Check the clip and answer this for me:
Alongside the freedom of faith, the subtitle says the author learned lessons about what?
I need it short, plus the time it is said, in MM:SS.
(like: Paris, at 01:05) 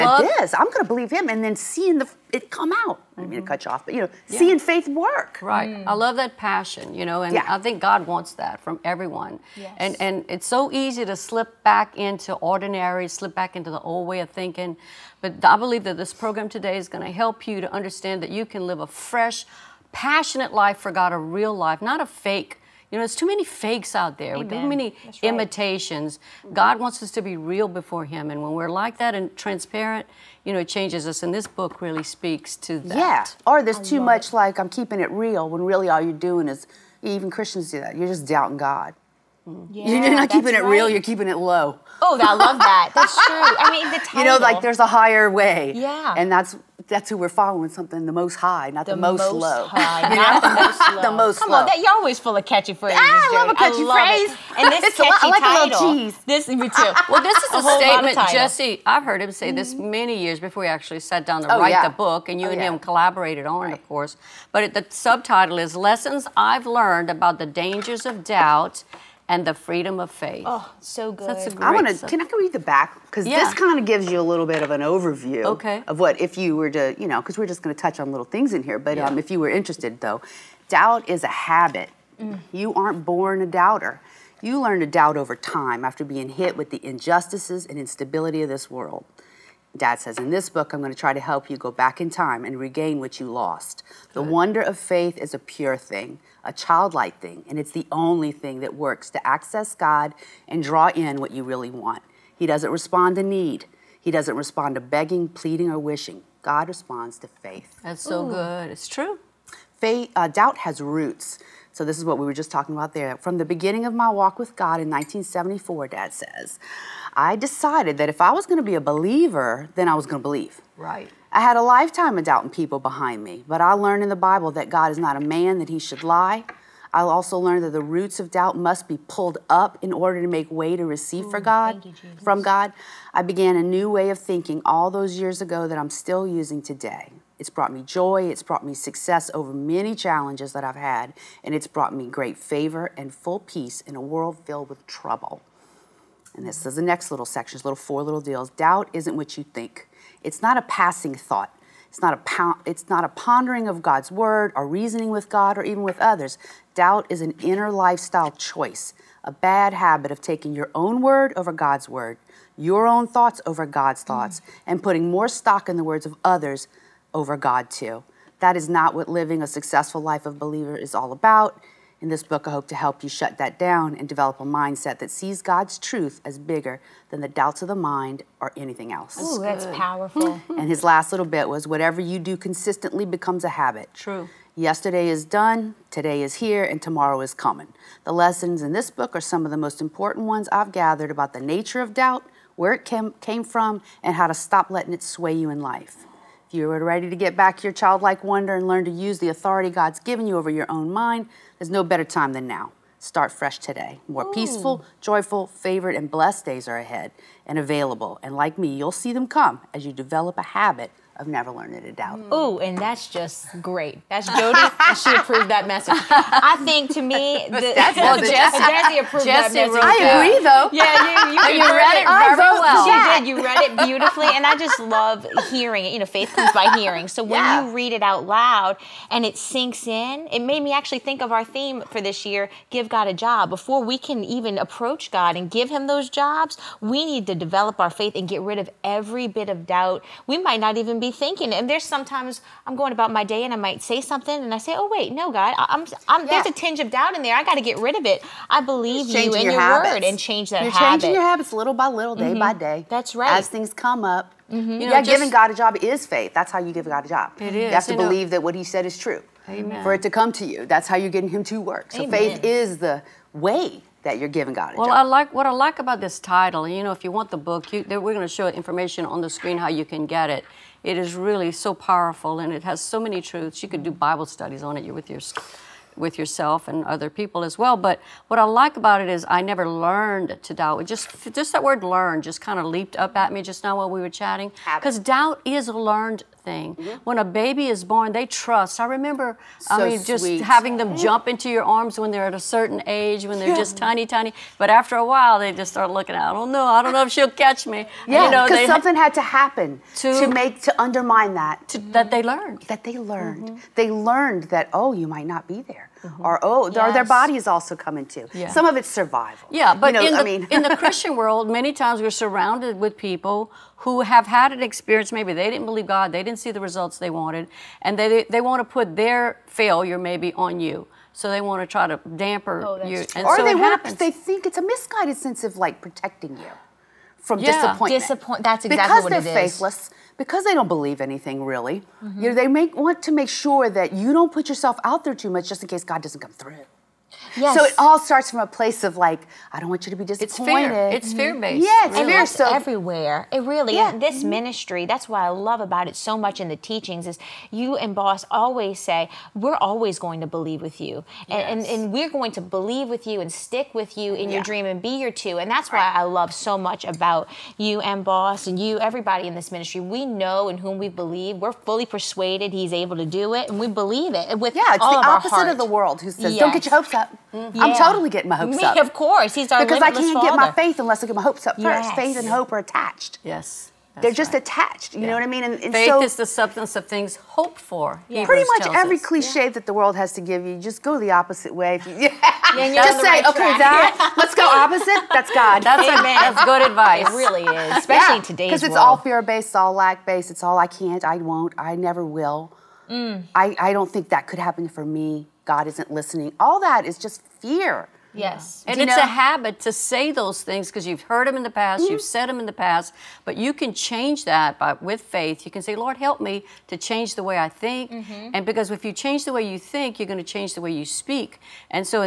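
The Dangers of Doubt, at 01:07.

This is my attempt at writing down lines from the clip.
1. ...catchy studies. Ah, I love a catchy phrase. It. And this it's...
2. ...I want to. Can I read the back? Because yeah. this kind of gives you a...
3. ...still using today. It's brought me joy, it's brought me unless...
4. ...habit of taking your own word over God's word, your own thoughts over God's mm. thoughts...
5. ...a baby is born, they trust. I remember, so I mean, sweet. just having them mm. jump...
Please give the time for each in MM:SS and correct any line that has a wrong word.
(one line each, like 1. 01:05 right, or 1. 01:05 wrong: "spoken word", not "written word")
1. 00:52 wrong: "phrases", not "studies"
2. 01:11 right
3. 02:15 wrong: "success", not "unless"
4. 02:39 right
5. 04:47 right.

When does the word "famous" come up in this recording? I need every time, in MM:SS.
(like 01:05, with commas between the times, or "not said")
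not said.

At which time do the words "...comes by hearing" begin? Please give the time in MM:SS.
03:46.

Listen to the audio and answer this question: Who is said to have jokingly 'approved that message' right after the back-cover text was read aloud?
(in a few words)
Jodi.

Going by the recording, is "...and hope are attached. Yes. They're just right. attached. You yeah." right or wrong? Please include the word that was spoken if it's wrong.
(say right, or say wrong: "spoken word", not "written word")
right.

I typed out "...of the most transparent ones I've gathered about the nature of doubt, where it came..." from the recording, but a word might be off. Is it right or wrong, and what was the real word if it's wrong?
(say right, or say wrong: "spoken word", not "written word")
wrong: "important", not "transparent".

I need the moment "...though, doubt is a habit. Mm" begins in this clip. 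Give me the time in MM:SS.
01:20.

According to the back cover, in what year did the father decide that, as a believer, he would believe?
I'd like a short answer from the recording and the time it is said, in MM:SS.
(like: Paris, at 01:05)
1974, at 01:54.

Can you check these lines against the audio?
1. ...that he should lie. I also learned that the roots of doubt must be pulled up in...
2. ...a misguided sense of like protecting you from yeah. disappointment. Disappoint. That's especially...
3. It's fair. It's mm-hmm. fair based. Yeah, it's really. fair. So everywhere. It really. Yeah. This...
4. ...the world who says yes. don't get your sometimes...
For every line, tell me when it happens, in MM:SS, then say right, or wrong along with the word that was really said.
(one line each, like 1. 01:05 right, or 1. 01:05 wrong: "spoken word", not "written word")
1. 02:05 right
2. 05:24 wrong: "exactly", not "especially"
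3. 05:40 right
4. 06:05 wrong: "hopes", not "sometimes".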